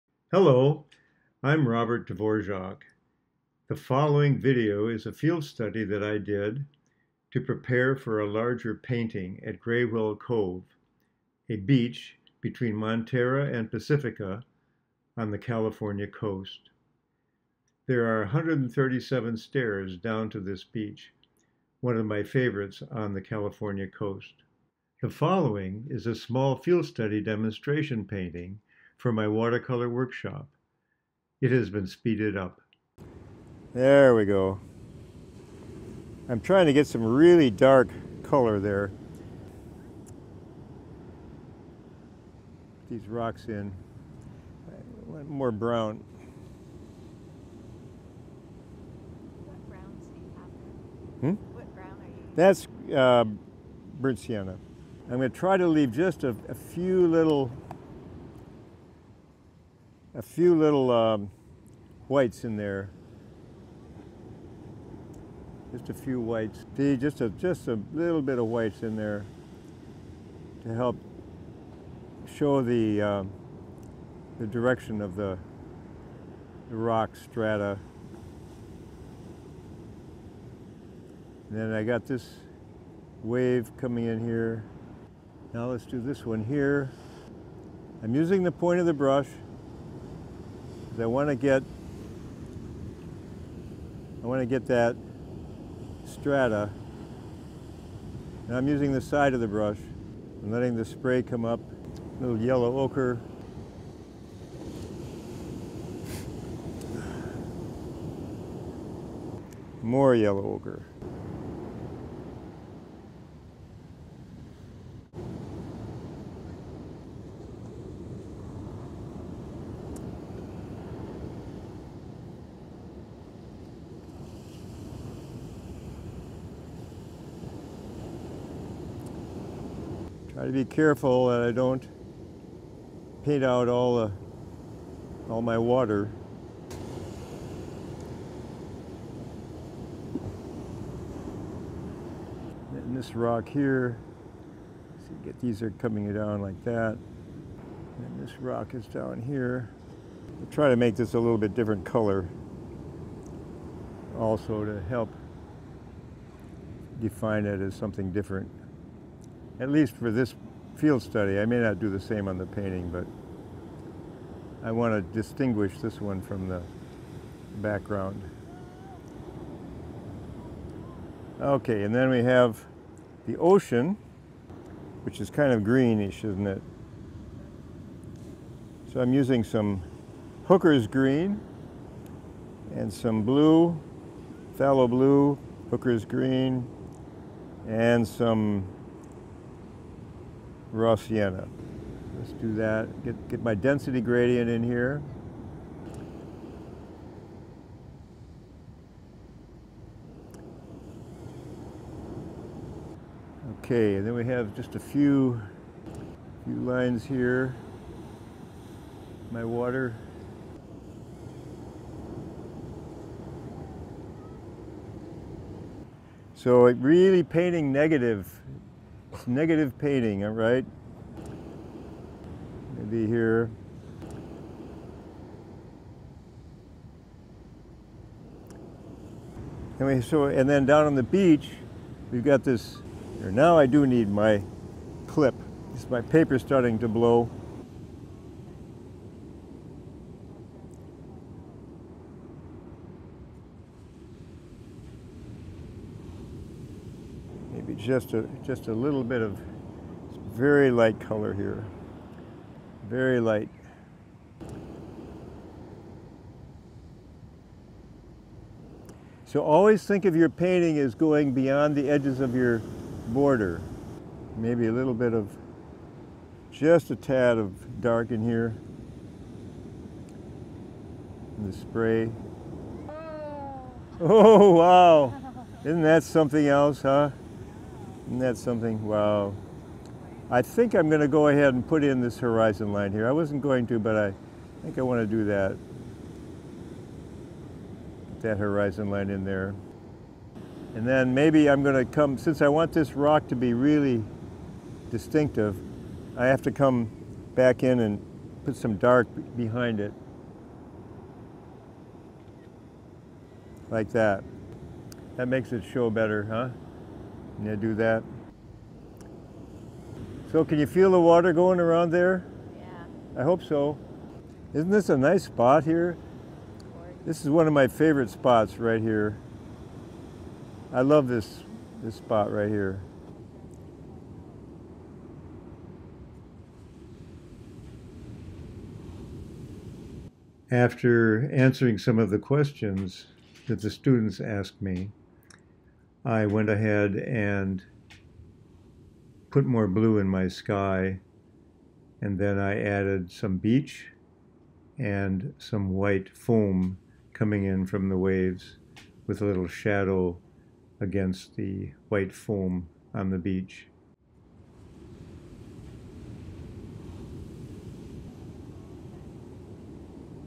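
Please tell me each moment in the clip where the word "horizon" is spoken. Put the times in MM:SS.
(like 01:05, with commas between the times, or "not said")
04:42, 04:48.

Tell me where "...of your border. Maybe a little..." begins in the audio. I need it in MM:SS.
04:22.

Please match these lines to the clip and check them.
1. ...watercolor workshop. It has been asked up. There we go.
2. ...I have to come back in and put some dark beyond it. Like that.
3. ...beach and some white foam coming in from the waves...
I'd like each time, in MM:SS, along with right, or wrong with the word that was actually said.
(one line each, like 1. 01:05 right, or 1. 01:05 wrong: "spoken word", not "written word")
1. 00:29 wrong: "speeded", not "asked"
2. 04:56 wrong: "behind", not "beyond"
3. 05:43 right.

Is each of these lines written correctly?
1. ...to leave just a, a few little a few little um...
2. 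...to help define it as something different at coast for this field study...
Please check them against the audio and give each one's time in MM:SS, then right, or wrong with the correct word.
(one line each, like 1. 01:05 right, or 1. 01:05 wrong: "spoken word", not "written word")
1. 00:55 right
2. 02:34 wrong: "least", not "coast".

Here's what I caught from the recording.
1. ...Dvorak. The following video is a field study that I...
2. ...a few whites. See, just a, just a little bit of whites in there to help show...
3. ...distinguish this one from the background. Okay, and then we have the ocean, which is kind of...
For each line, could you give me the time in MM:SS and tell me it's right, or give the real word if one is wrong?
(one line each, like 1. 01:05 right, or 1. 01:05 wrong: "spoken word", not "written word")
1. 00:02 right
2. 01:05 right
3. 02:45 right.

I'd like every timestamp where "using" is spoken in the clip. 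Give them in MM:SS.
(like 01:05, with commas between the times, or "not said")
01:28, 01:38, 02:59.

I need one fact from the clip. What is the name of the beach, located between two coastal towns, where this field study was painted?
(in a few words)
Gray Whale Cove.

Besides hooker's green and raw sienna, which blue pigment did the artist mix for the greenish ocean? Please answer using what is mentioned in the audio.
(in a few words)
phthalo blue.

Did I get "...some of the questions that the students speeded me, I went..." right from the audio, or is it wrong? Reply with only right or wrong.
wrong.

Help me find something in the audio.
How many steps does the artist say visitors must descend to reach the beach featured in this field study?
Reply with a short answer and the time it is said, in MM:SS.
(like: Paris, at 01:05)
137, at 00:18.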